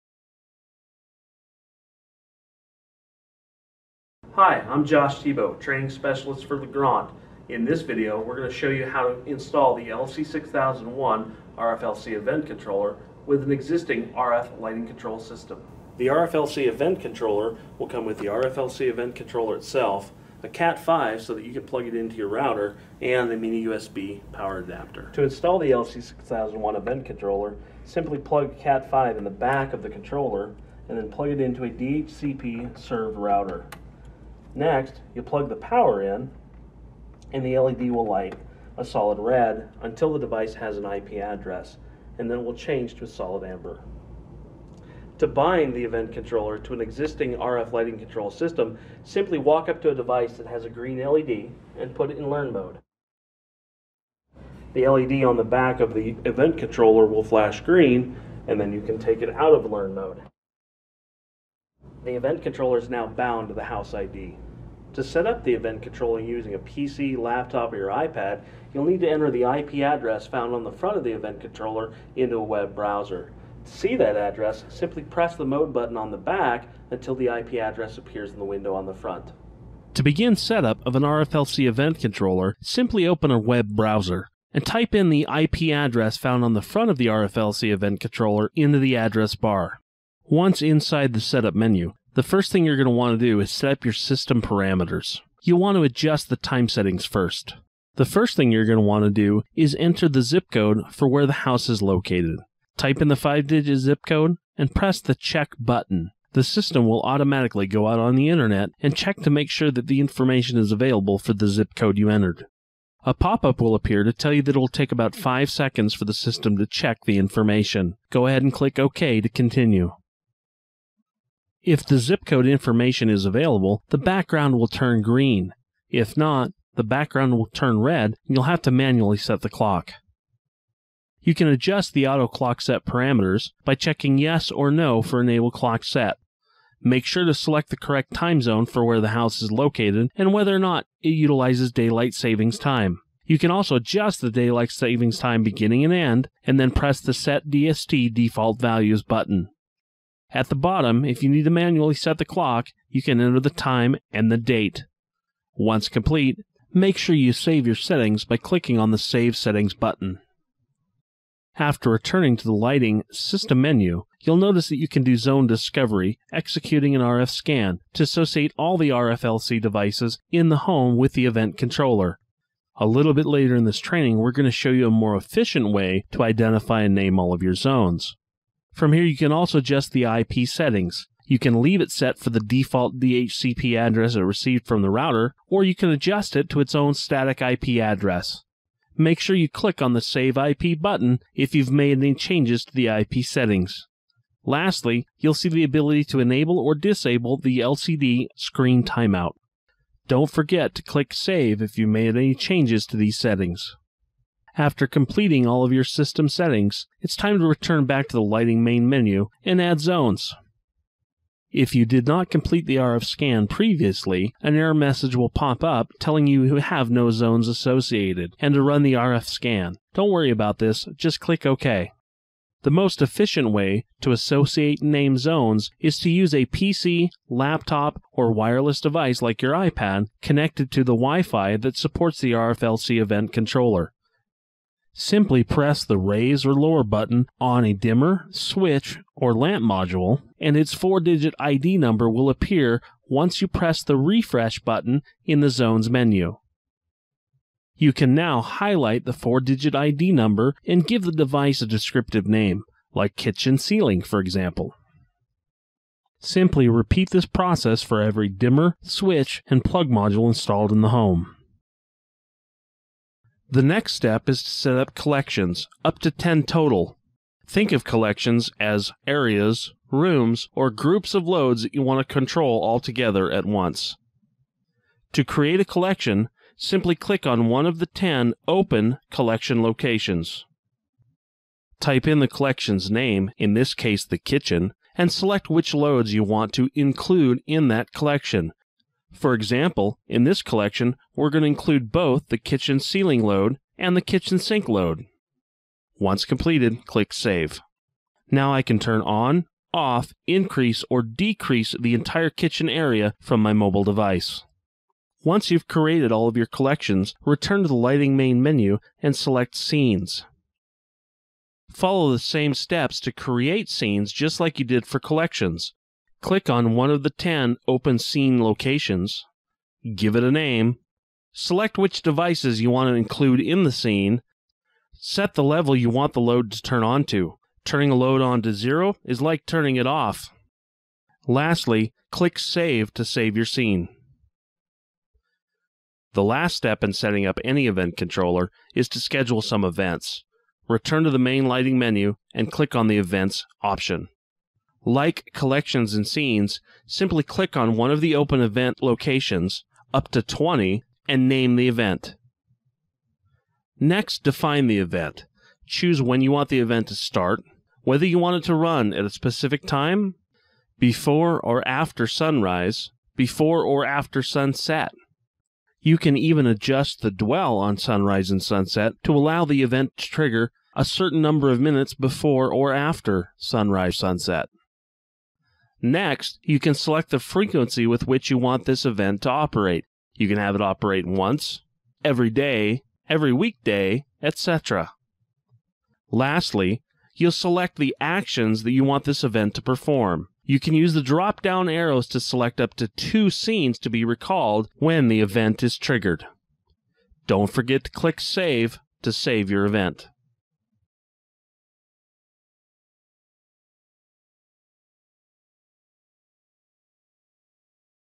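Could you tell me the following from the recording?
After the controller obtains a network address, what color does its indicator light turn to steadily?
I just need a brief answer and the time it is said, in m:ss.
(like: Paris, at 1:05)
Amber, at 0:43.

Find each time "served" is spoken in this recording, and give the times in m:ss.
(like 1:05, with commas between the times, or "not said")
0:32.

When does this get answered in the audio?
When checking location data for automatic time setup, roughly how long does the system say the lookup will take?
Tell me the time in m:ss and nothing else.
1:54.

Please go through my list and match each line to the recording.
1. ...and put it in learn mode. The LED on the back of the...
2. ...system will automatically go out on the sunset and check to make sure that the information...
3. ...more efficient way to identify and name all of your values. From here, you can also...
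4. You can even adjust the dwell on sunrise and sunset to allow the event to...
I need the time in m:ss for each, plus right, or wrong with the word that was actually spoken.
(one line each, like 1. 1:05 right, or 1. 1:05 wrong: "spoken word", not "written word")
1. 0:51 right
2. 1:46 wrong: "internet", not "sunset"
3. 2:54 wrong: "zones", not "values"
4. 6:05 right.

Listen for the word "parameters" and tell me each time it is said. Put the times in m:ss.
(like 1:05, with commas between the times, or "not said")
1:34, 2:12.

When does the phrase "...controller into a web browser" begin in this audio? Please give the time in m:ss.
1:11.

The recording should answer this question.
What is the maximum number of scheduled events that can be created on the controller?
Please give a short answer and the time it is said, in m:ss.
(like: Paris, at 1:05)
20, at 5:49.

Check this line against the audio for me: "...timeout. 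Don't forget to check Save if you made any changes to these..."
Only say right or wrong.
wrong.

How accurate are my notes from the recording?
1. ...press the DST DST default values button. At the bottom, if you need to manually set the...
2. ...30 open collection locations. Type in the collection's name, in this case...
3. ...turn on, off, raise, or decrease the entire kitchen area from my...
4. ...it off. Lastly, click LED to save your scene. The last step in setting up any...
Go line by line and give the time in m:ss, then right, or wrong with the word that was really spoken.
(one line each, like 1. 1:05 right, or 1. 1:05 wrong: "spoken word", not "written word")
1. 2:26 wrong: "Set", not "DST"
2. 4:37 wrong: "10", not "30"
3. 4:58 wrong: "increase", not "raise"
4. 5:29 wrong: "Save", not "LED".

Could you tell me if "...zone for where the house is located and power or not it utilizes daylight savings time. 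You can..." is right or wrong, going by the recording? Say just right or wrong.
wrong.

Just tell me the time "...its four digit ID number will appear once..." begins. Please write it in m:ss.
4:00.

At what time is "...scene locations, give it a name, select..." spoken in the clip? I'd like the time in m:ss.
5:17.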